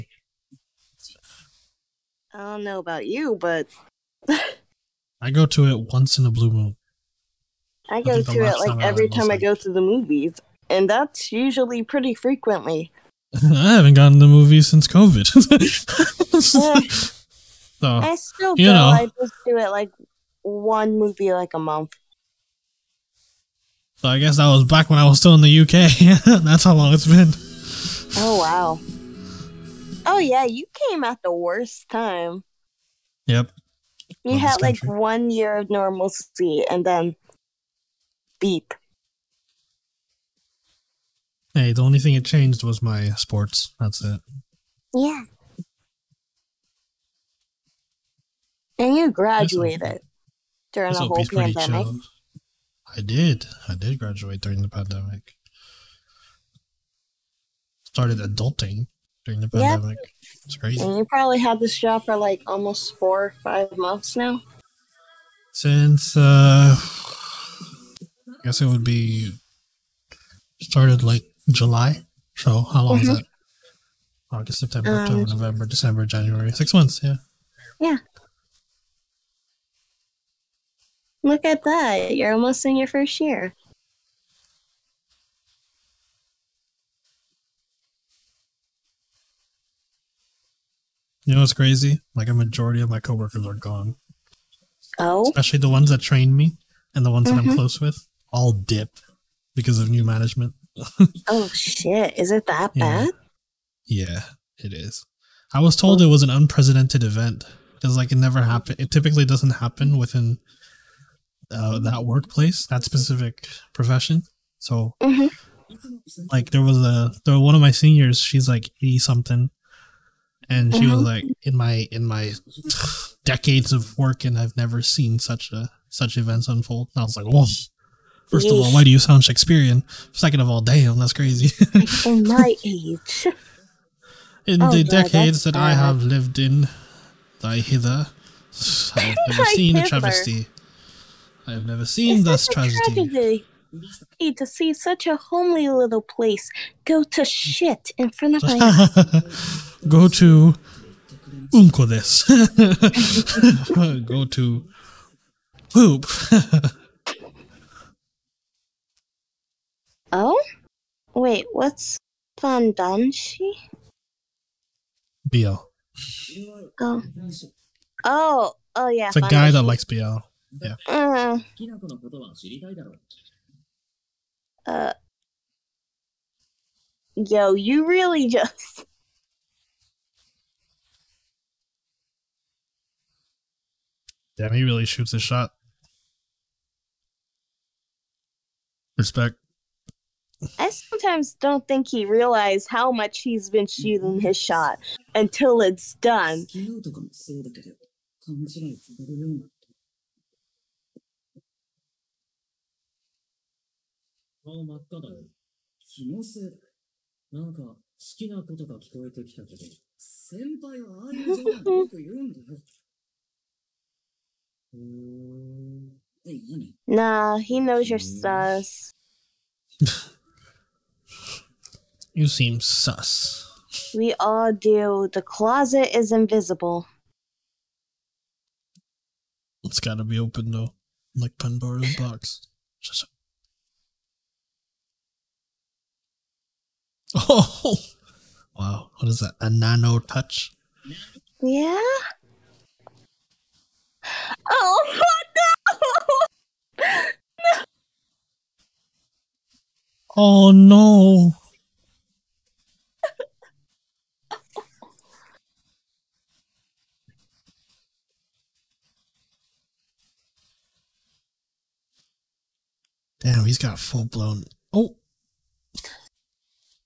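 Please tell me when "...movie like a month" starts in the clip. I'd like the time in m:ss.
0:20.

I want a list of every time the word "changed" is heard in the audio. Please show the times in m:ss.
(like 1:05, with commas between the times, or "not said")
0:42.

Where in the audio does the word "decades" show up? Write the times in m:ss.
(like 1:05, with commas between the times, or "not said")
2:03, 2:15.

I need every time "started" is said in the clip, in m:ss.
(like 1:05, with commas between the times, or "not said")
0:57, 1:10.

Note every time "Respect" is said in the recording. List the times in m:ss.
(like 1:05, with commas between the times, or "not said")
3:08.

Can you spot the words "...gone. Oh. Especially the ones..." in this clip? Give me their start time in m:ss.
1:33.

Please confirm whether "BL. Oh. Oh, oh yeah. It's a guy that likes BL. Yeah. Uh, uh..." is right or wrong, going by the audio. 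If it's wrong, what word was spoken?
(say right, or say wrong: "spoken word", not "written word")
right.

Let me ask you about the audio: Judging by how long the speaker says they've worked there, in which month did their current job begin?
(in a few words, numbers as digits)
July.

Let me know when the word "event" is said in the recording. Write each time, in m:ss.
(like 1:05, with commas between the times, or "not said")
1:47, 2:06.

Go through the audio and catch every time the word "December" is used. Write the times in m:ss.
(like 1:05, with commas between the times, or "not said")
1:15.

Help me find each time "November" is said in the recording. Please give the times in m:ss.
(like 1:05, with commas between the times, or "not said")
1:15.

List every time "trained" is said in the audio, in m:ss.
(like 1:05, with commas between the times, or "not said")
1:36.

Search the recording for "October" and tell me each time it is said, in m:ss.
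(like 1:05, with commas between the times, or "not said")
1:14.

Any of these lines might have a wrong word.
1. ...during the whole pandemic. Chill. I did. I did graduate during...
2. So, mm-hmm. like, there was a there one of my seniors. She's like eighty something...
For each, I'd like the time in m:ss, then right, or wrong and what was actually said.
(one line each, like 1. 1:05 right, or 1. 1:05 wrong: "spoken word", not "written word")
1. 0:50 right
2. 1:54 right.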